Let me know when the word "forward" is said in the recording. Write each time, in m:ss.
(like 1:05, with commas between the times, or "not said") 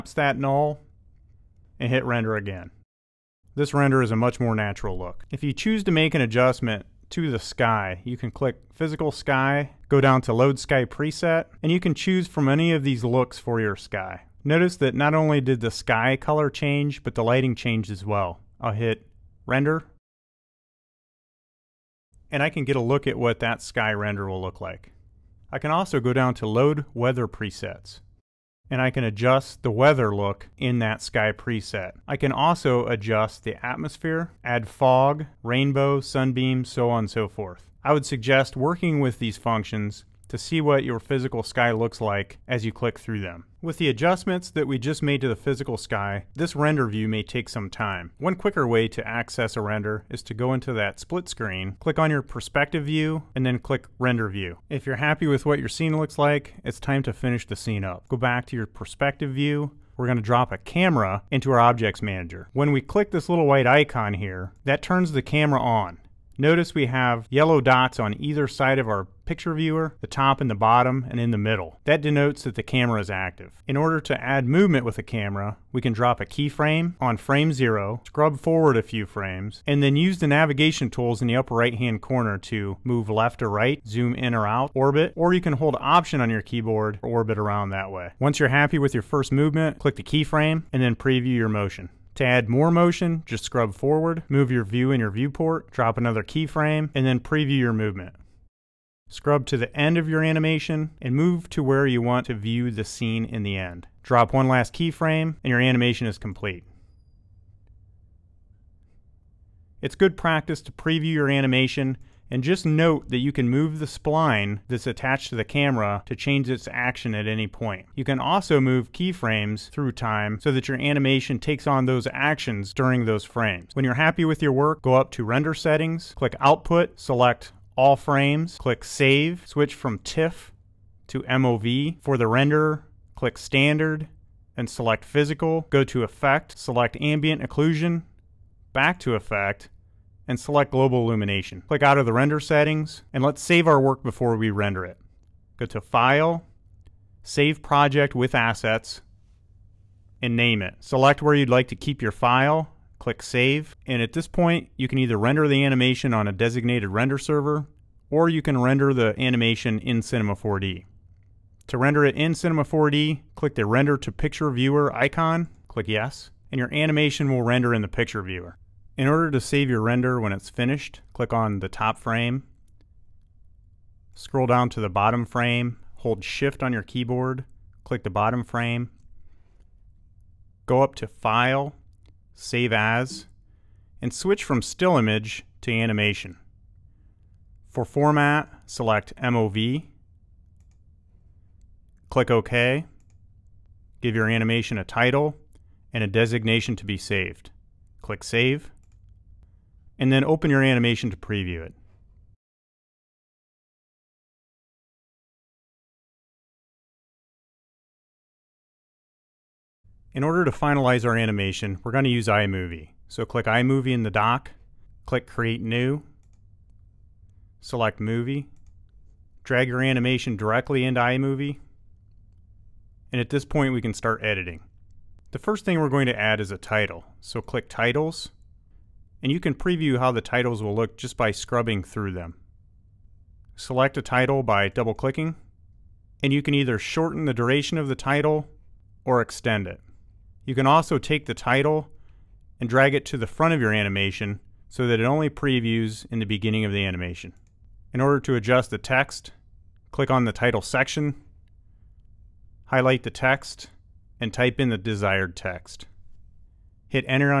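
1:18, 1:33.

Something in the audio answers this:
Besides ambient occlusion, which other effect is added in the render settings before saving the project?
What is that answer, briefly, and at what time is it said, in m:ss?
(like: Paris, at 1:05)
Global Illumination, at 2:20.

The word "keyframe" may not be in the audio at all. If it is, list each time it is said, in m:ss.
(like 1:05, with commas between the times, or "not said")
1:16, 1:30, 1:36, 1:44, 1:58.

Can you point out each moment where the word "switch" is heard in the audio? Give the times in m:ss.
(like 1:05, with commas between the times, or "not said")
2:09, 3:04.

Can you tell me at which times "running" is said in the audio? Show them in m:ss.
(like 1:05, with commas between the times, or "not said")
not said.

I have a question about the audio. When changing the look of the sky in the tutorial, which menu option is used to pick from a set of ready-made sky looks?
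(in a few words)
Load Sky Preset.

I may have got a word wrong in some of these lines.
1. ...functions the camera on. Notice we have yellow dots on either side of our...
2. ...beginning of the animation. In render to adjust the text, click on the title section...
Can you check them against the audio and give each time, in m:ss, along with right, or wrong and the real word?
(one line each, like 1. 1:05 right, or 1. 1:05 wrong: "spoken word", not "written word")
1. 1:04 wrong: "turns", not "functions"
2. 4:06 wrong: "order", not "render".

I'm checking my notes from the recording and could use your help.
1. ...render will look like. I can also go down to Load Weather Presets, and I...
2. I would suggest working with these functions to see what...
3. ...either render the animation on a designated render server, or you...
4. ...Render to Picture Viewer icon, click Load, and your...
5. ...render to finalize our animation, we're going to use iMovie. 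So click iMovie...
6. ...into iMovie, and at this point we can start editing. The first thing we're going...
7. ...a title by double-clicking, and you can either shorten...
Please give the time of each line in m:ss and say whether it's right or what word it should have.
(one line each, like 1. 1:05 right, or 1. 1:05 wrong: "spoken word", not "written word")
1. 0:23 right
2. 0:37 right
3. 2:34 right
4. 2:43 wrong: "Yes", not "Load"
5. 3:30 wrong: "order", not "render"
6. 3:40 right
7. 3:53 right.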